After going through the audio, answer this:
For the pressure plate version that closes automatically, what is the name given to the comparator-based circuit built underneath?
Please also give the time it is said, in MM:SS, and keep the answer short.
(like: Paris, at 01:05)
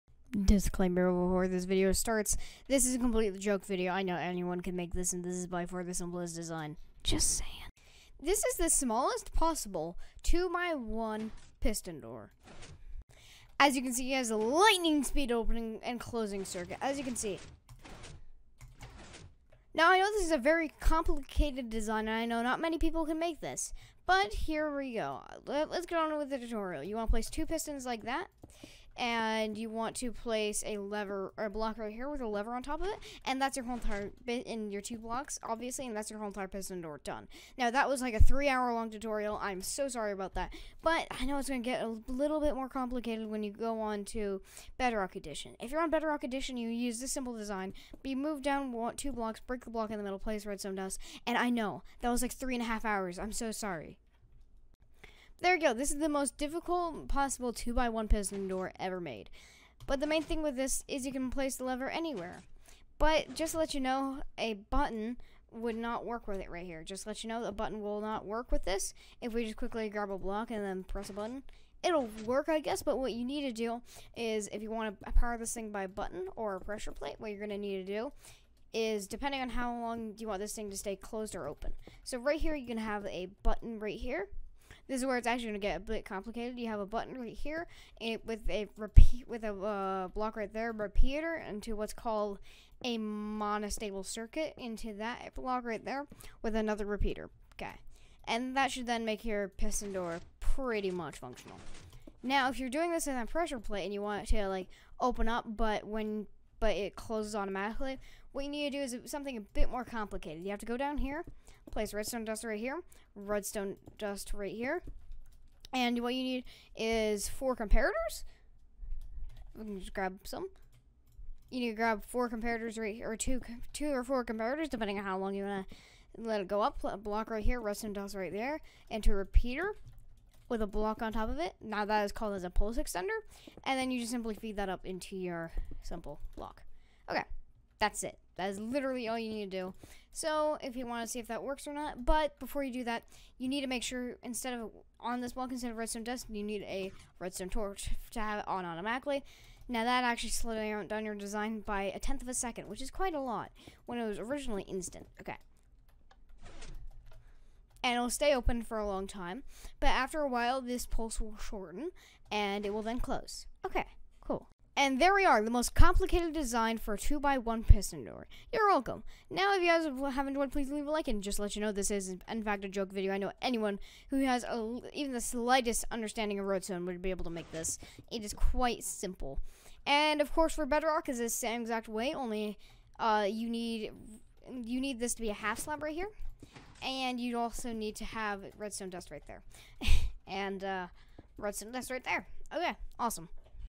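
pulse extender, at 02:12.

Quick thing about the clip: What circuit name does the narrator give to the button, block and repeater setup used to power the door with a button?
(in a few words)
monostable circuit.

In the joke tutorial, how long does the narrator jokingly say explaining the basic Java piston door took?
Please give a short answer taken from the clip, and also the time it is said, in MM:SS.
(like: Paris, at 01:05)
3 hours, at 00:38.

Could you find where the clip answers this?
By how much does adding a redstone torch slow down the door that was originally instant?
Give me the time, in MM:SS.
02:31.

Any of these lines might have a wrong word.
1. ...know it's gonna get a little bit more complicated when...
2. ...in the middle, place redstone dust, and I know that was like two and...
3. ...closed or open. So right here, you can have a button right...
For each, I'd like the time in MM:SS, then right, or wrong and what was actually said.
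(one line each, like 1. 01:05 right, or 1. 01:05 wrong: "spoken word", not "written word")
1. 00:41 right
2. 00:49 wrong: "three", not "two"
3. 01:20 right.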